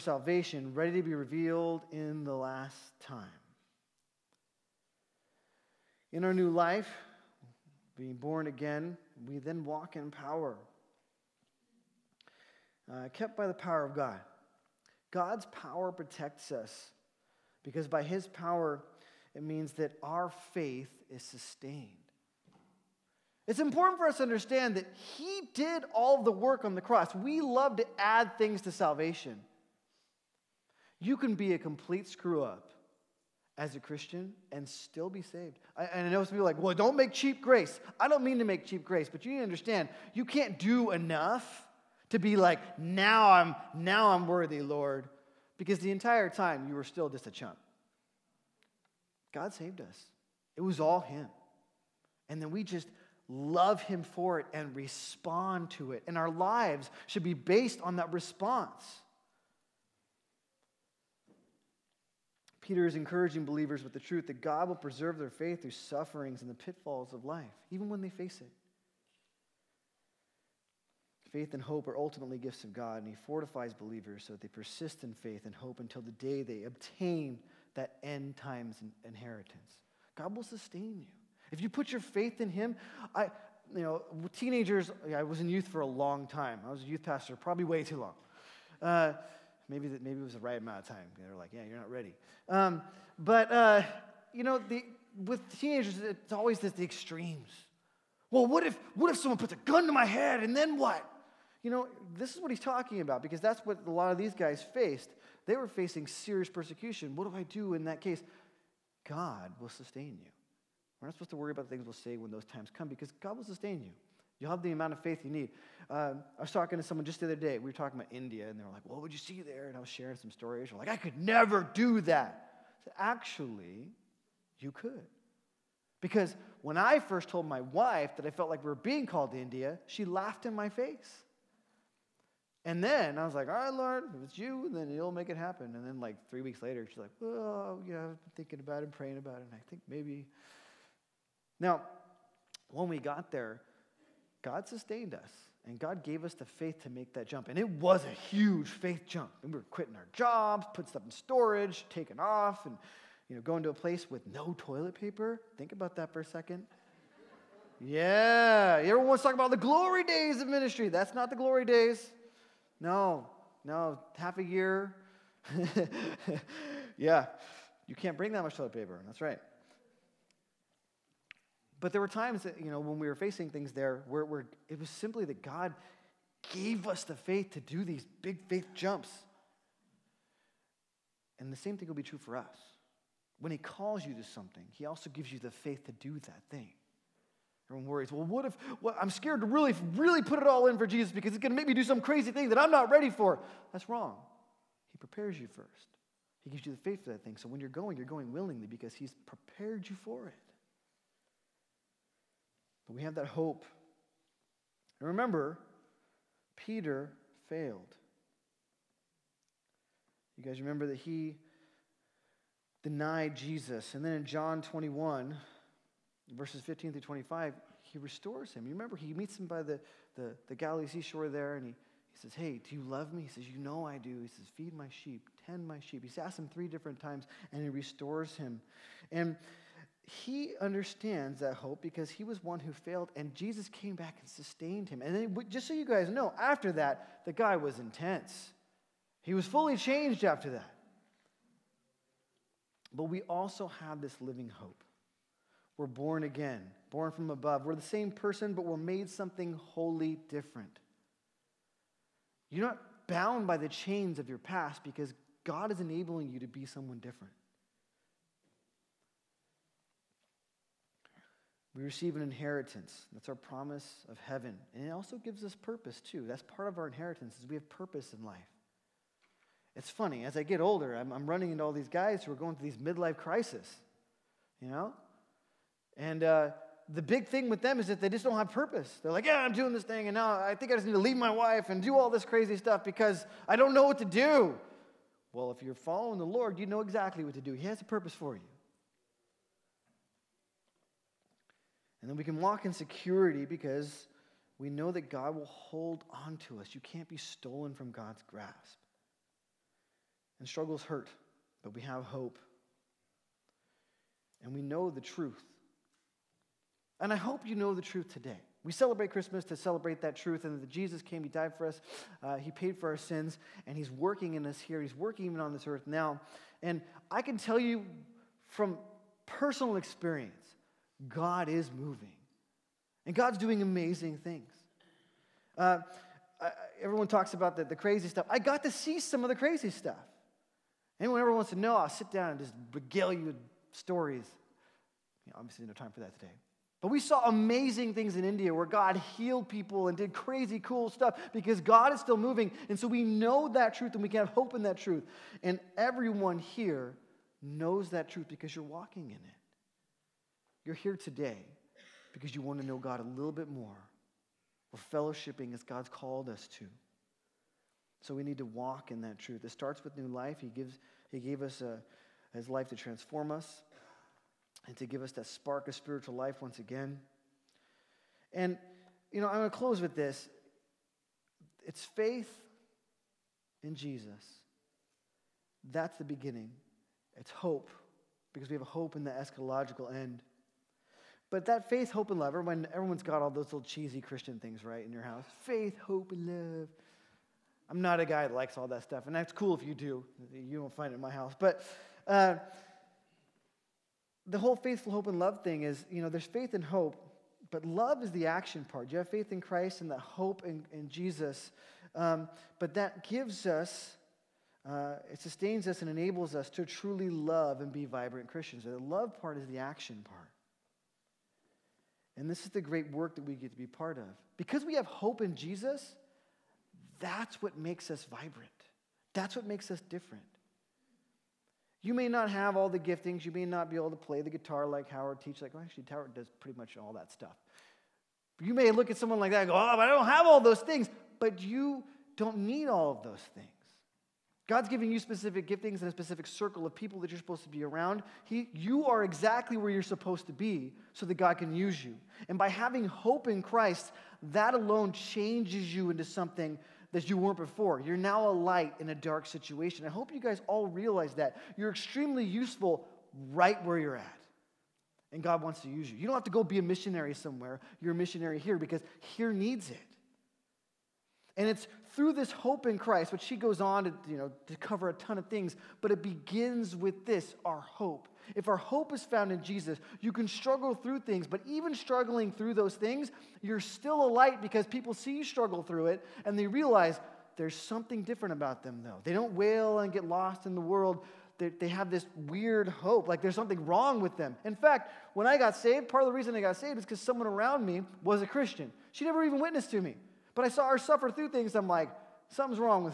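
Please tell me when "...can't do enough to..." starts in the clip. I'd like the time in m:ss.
0:40.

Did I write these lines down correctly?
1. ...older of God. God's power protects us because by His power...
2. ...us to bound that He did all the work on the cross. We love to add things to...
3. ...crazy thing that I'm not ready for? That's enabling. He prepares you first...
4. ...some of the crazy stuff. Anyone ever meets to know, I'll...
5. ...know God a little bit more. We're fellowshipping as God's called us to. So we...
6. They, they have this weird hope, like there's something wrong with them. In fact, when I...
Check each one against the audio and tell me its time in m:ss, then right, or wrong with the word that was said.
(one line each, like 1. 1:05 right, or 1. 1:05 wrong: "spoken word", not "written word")
1. 0:13 wrong: "power", not "older"
2. 0:24 wrong: "understand", not "bound"
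3. 3:11 wrong: "wrong", not "enabling"
4. 5:28 wrong: "wants", not "meets"
5. 5:52 right
6. 8:01 right.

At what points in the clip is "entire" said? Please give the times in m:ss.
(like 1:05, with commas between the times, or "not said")
0:45.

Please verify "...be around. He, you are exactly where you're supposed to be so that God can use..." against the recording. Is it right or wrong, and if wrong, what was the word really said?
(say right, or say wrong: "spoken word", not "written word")
right.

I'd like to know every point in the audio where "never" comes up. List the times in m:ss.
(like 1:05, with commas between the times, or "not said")
2:01, 8:09.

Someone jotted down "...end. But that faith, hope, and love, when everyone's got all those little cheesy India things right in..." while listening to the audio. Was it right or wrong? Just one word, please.
wrong.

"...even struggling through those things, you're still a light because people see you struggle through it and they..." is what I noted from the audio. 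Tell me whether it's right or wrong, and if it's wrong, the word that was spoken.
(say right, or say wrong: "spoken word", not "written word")
right.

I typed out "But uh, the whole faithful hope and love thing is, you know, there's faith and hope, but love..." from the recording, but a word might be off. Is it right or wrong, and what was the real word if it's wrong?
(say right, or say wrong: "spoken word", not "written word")
right.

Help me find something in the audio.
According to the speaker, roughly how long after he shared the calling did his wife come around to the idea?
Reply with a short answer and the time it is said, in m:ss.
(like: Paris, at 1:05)
3 weeks, at 2:16.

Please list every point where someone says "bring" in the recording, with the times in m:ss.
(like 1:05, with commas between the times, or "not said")
2:48.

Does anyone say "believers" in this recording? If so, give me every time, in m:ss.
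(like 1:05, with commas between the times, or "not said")
1:03, 1:13.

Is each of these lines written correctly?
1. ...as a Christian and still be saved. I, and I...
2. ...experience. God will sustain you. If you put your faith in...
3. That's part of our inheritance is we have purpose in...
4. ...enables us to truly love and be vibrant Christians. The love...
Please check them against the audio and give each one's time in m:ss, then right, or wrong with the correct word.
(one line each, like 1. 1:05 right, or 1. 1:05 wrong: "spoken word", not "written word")
1. 0:33 right
2. 1:19 wrong: "inheritance", not "experience"
3. 4:26 right
4. 6:45 right.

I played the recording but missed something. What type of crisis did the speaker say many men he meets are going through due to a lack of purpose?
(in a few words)
Midlife crises.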